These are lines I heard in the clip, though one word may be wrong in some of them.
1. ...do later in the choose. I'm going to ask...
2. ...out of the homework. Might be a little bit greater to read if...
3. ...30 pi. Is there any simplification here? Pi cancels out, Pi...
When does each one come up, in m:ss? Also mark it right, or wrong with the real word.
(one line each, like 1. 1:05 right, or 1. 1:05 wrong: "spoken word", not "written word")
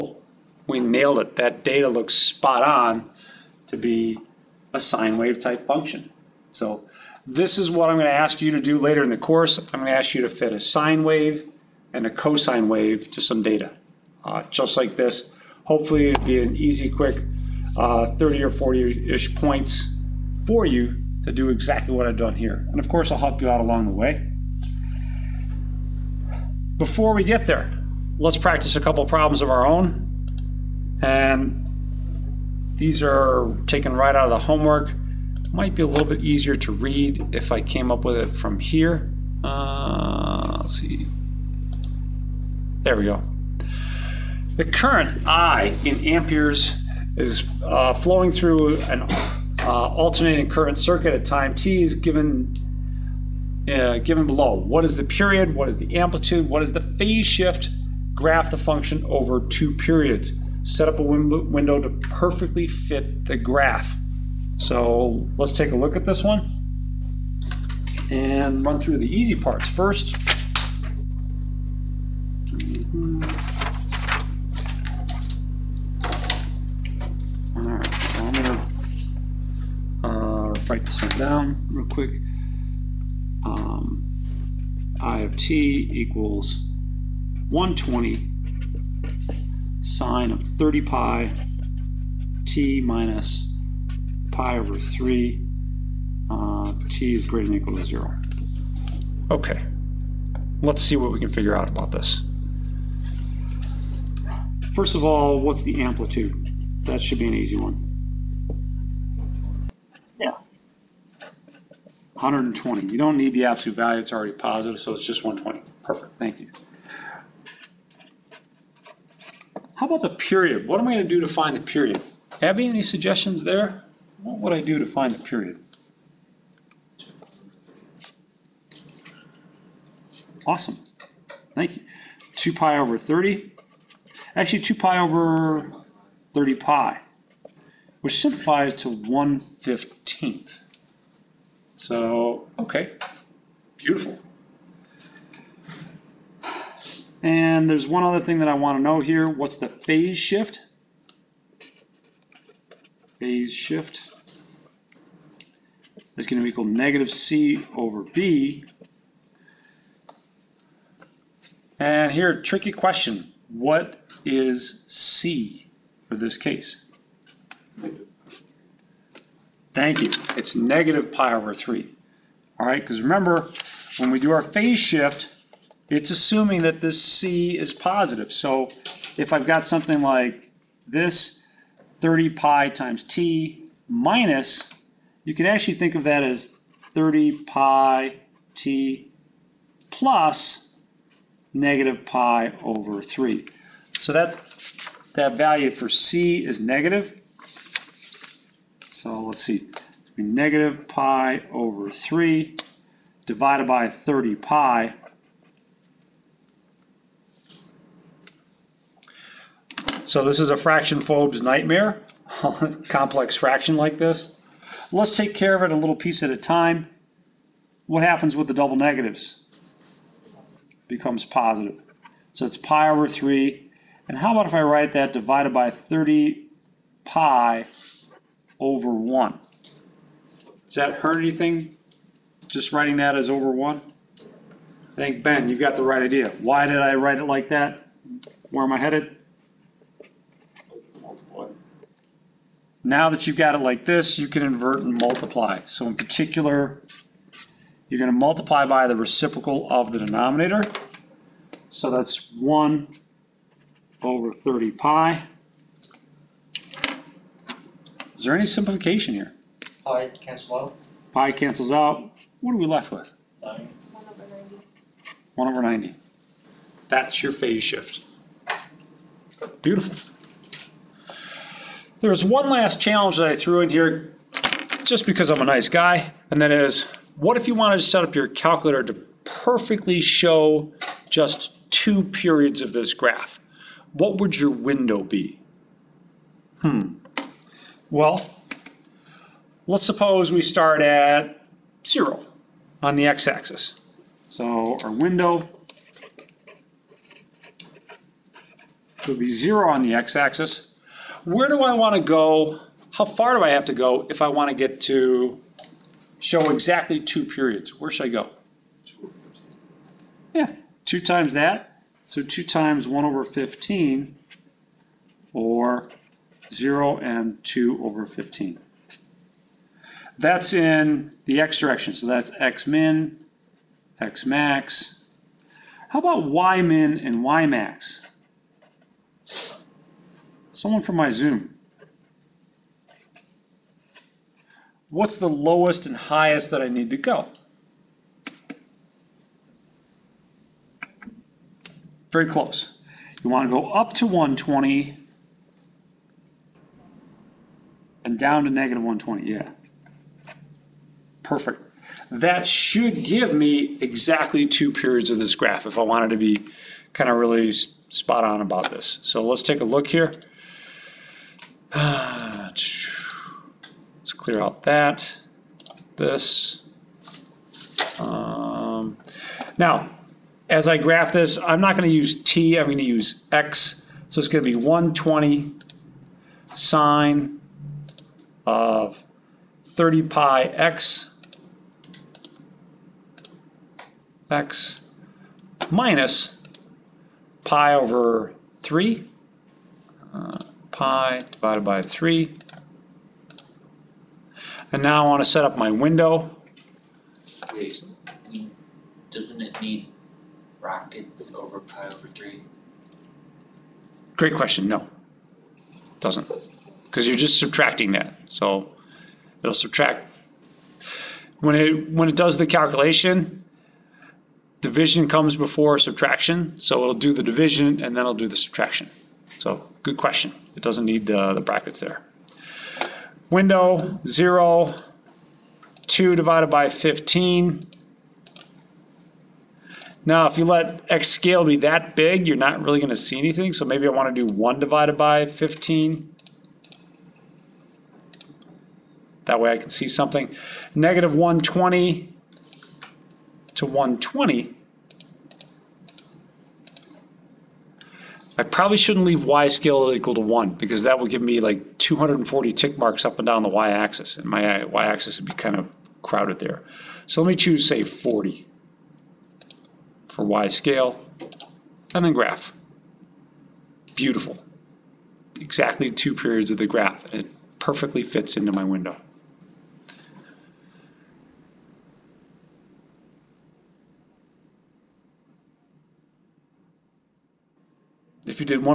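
1. 0:08 wrong: "course", not "choose"
2. 0:34 wrong: "easier", not "greater"
3. 4:14 right.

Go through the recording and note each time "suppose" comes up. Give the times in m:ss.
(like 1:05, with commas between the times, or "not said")
4:49.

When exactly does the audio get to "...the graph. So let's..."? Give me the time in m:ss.
1:03.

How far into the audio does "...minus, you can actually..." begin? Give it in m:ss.
3:03.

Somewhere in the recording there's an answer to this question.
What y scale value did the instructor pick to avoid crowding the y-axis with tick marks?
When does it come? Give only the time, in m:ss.
7:37.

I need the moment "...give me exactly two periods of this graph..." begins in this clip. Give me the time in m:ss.
5:53.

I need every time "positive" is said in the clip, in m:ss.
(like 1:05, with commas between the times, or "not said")
1:54, 2:57, 3:41.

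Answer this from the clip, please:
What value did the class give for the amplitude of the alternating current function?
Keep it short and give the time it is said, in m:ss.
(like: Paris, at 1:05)
120, at 1:52.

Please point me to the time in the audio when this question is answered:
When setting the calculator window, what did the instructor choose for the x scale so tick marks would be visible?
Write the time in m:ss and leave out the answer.
7:14.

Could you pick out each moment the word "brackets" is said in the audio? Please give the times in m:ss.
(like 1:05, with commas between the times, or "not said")
6:40, 7:01.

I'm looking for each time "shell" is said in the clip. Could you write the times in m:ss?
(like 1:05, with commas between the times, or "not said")
not said.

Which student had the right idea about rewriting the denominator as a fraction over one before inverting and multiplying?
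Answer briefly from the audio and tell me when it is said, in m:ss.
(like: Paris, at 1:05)
Ben, at 3:55.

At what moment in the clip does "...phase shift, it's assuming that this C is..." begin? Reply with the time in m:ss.
2:54.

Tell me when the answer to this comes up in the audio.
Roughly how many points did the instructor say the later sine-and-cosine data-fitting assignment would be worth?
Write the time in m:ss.
0:18.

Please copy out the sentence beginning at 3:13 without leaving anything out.
So that's, that value for c is negative.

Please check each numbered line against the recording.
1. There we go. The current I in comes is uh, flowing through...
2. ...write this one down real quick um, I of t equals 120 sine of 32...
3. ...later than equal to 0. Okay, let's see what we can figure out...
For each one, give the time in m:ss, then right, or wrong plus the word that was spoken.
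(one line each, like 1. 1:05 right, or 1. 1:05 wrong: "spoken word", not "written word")
1. 0:42 wrong: "amperes", not "comes"
2. 1:20 wrong: "30", not "32"
3. 1:37 wrong: "greater", not "later".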